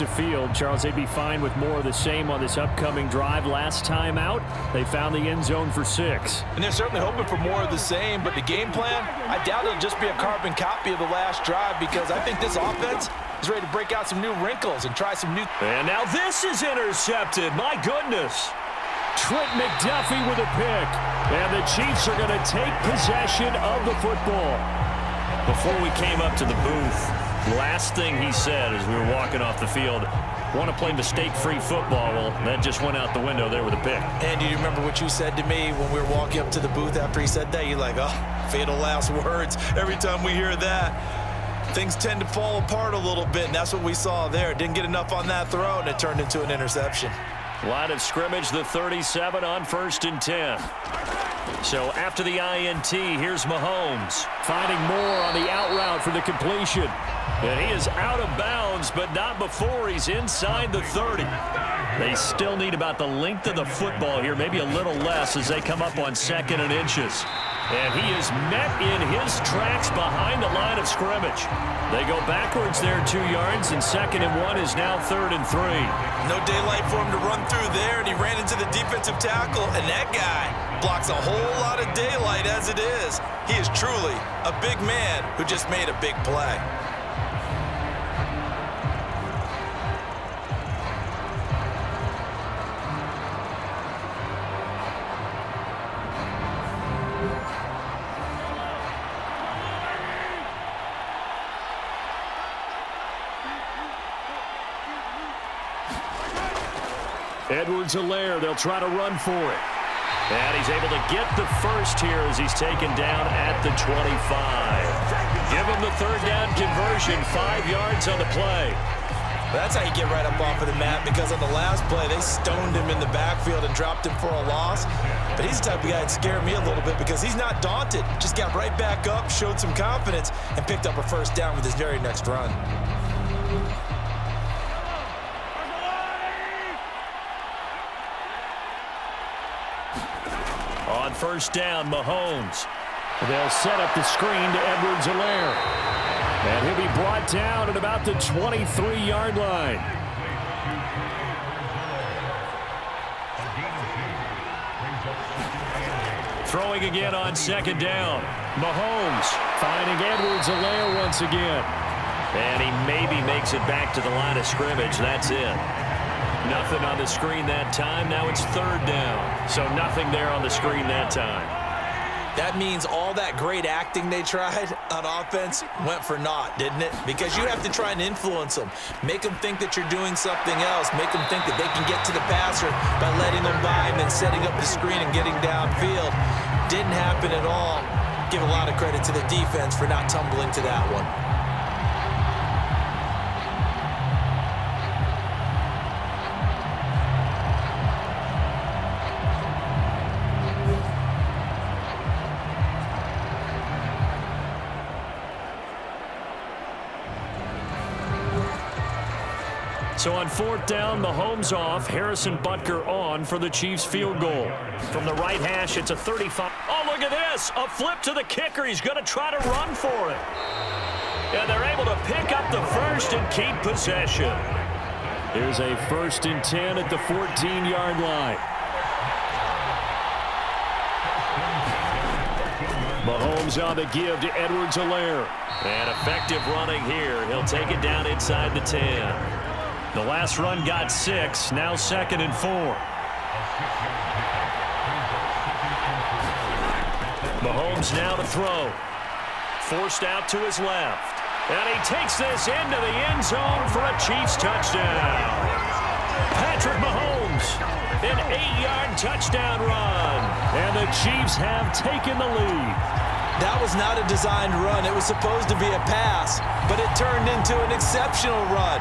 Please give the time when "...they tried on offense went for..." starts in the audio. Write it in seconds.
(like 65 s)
174 s.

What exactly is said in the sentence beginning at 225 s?
Here's a first and 10 at the 14-yard line.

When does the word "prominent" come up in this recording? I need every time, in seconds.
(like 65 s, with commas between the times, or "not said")
not said.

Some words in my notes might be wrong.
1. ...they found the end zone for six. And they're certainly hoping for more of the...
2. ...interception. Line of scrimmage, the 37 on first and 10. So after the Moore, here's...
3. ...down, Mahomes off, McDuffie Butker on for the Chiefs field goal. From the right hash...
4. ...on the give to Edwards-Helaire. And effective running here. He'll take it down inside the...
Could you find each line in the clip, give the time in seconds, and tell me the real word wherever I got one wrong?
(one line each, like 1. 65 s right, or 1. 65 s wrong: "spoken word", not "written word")
1. 4 s right
2. 46 s wrong: "INT", not "Moore"
3. 210 s wrong: "Harrison", not "McDuffie"
4. 233 s right.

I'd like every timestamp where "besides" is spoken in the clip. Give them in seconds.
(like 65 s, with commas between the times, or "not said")
not said.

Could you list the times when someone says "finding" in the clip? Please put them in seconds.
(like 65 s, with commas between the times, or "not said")
54 s, 159 s.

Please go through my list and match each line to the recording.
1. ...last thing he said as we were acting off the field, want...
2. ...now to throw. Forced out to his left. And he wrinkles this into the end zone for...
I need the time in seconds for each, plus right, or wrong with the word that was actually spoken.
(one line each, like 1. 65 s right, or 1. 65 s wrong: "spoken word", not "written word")
1. 27 s wrong: "walking", not "acting"
2. 247 s wrong: "takes", not "wrinkles".